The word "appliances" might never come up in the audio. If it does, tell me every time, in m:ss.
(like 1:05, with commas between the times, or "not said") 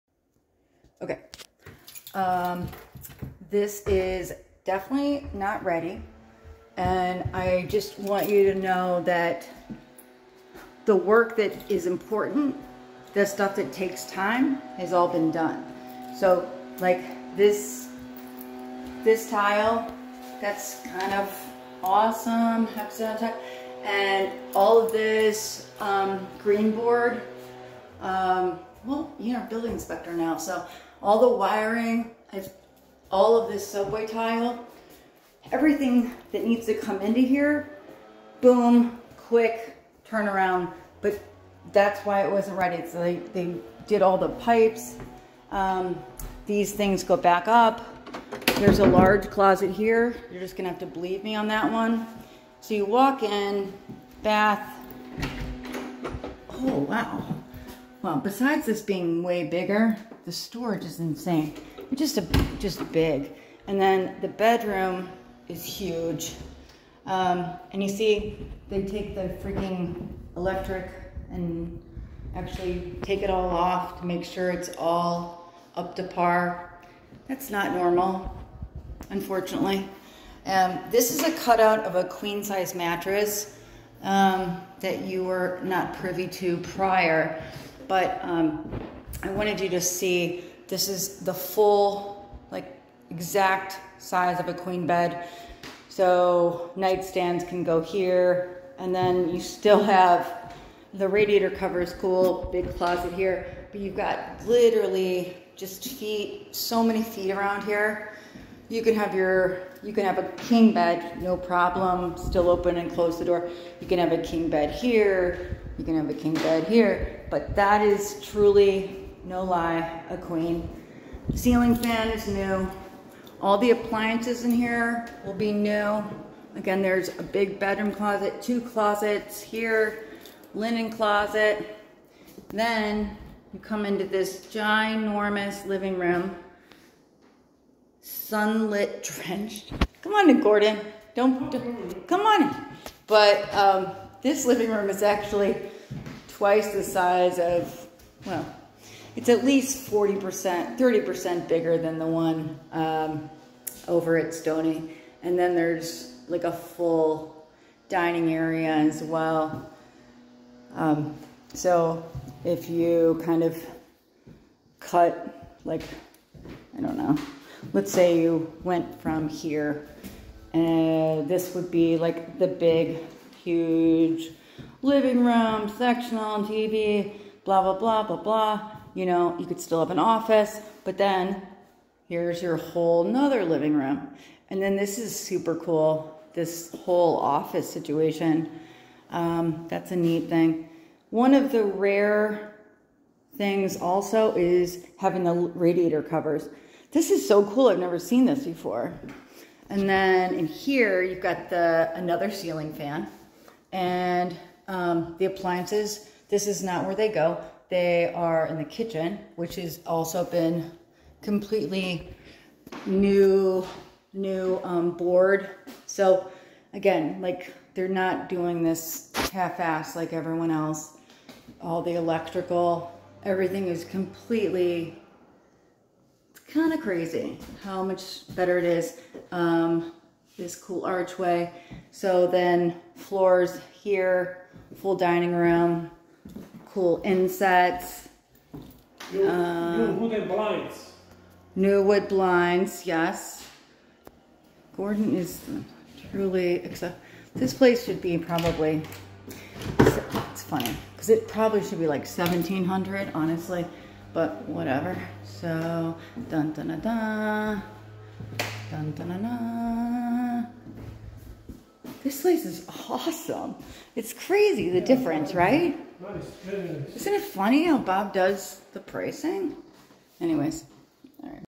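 2:03, 3:25.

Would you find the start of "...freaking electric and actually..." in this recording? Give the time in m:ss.
1:09.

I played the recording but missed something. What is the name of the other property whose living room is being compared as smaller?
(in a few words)
Stony.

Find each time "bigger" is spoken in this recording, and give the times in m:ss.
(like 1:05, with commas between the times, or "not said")
0:59, 2:31.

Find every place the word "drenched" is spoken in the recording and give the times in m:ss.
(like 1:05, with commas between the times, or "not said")
2:19.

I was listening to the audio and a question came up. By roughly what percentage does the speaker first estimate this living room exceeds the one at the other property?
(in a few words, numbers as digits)
40%.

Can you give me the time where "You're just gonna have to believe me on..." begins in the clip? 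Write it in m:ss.
0:50.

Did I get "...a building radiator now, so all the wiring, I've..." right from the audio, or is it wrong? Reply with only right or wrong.
wrong.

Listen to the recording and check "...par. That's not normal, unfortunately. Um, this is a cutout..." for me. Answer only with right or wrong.
right.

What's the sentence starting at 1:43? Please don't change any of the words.
But you've got literally just feet, so many feet around here.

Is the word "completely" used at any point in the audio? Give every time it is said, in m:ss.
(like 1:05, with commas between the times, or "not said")
3:31, 3:43.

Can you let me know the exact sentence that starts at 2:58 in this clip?
You know, you could still have an office, but then here's your whole nother living room.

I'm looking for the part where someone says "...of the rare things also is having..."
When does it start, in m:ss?
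3:11.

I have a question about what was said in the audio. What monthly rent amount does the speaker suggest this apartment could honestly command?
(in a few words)
1700.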